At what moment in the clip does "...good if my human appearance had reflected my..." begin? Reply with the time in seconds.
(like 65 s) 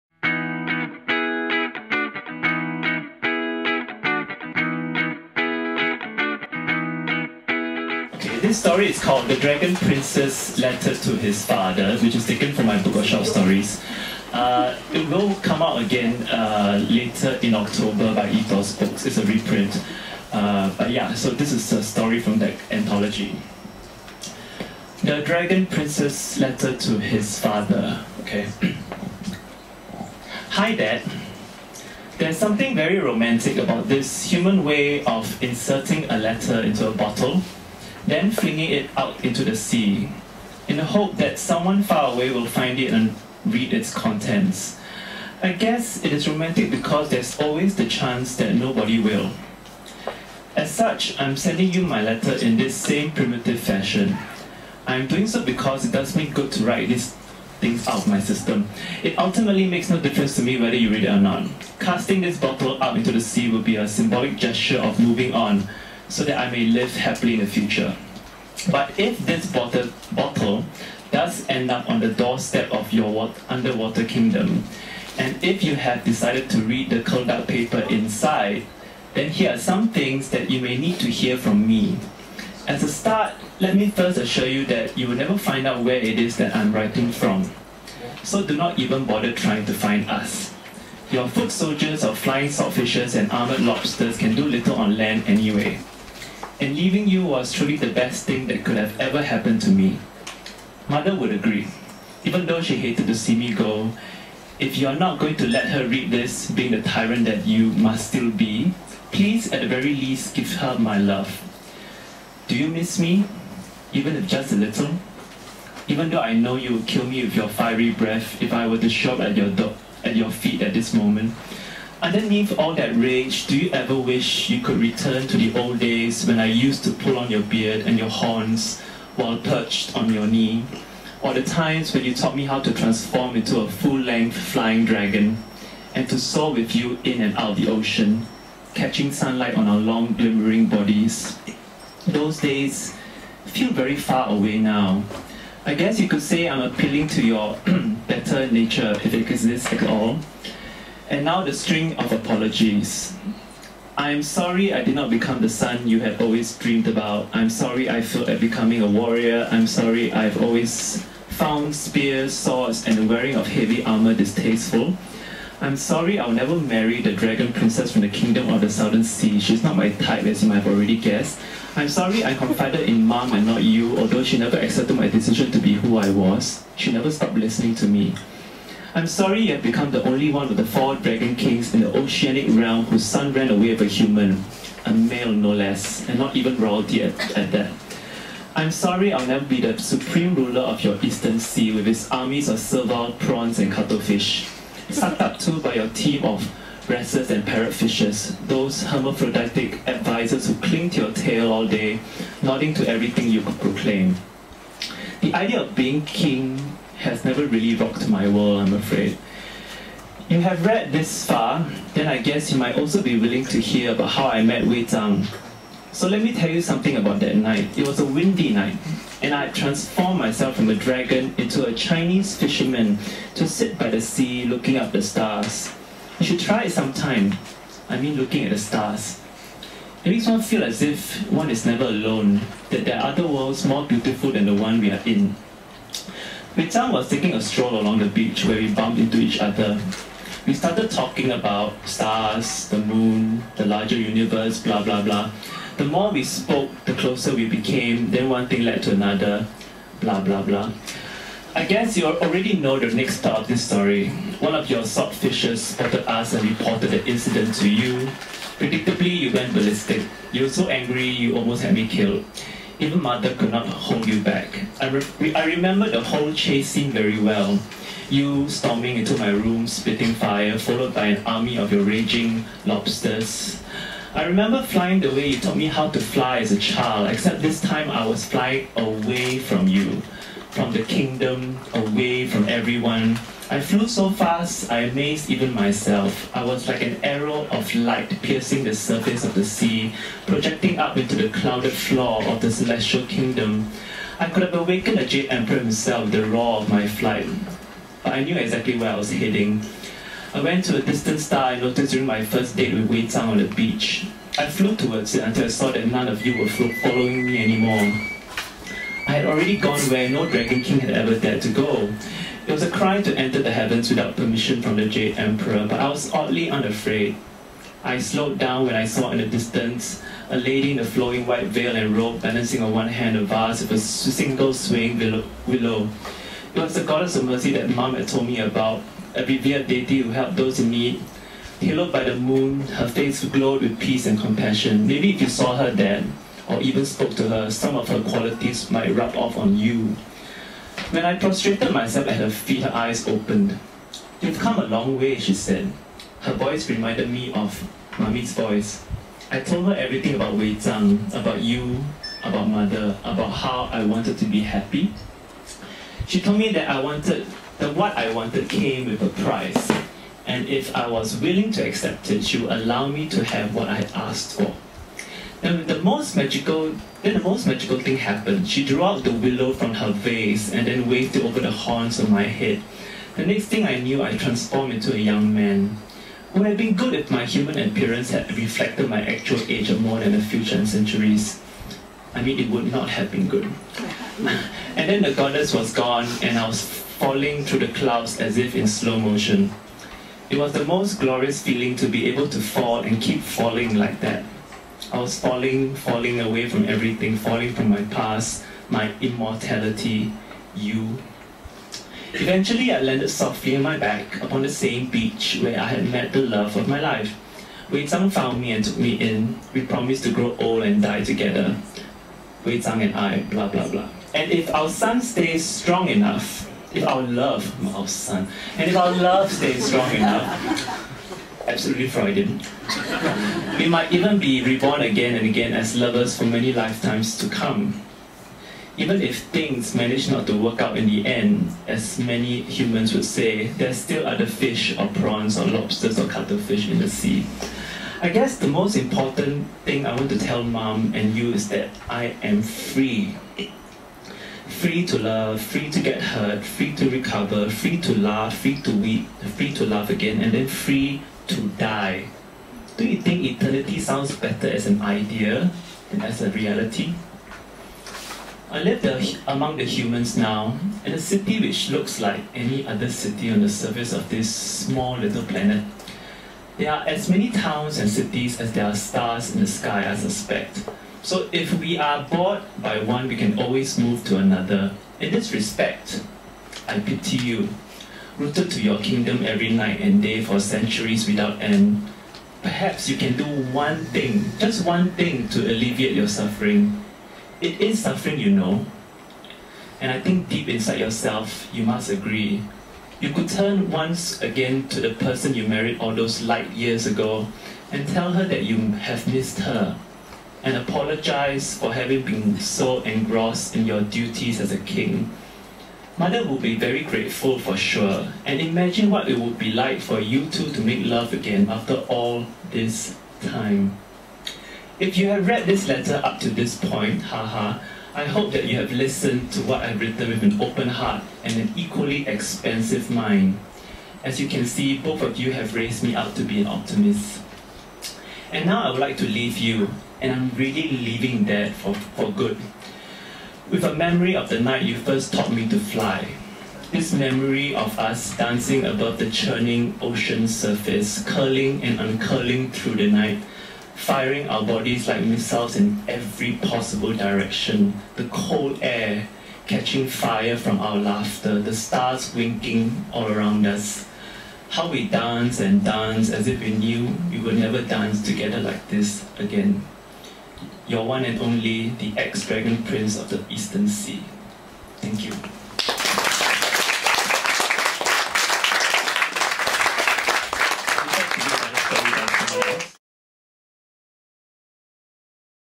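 376 s.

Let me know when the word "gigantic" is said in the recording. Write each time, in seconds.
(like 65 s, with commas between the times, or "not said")
not said.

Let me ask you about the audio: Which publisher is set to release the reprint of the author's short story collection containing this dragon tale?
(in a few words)
Ethos Books.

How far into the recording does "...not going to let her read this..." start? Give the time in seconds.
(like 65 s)
104 s.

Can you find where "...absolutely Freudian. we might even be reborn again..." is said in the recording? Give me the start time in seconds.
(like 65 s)
421 s.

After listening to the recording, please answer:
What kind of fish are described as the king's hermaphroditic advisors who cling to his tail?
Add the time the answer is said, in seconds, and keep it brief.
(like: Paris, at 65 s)
parrotfishes, at 197 s.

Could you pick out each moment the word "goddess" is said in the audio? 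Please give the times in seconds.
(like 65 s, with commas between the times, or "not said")
326 s, 385 s.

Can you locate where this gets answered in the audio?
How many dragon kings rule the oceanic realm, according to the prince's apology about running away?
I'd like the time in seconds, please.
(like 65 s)
180 s.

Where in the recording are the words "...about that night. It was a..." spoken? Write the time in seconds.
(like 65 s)
216 s.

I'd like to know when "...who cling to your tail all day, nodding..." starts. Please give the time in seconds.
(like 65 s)
200 s.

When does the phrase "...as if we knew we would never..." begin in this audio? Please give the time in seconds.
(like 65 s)
556 s.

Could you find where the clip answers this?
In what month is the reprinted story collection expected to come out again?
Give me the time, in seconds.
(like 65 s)
17 s.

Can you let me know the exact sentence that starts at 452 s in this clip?
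Do you think eternity sounds better as an idea than as a reality?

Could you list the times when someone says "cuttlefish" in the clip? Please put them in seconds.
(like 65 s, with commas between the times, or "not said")
193 s, 436 s.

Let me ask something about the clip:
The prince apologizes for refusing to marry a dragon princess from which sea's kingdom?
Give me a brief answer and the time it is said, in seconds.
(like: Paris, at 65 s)
the southern sea, at 168 s.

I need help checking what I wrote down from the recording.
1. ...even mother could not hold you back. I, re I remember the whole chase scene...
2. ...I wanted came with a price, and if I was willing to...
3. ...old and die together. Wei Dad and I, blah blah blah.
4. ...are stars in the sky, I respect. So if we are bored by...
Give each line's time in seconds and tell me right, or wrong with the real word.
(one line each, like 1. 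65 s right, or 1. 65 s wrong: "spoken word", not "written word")
1. 262 s right
2. 357 s right
3. 410 s wrong: "Zhang", not "Dad"
4. 468 s wrong: "suspect", not "respect".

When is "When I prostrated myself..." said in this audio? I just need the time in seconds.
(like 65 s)
340 s.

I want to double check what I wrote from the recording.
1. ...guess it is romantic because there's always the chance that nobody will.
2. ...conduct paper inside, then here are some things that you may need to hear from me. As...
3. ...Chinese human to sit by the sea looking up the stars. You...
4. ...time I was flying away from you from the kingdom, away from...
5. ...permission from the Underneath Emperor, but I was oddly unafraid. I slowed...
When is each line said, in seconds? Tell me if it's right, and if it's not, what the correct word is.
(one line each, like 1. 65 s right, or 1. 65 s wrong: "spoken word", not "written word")
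1. 45 s right
2. 77 s right
3. 221 s wrong: "fisherman", not "human"
4. 277 s right
5. 314 s wrong: "Jade", not "Underneath".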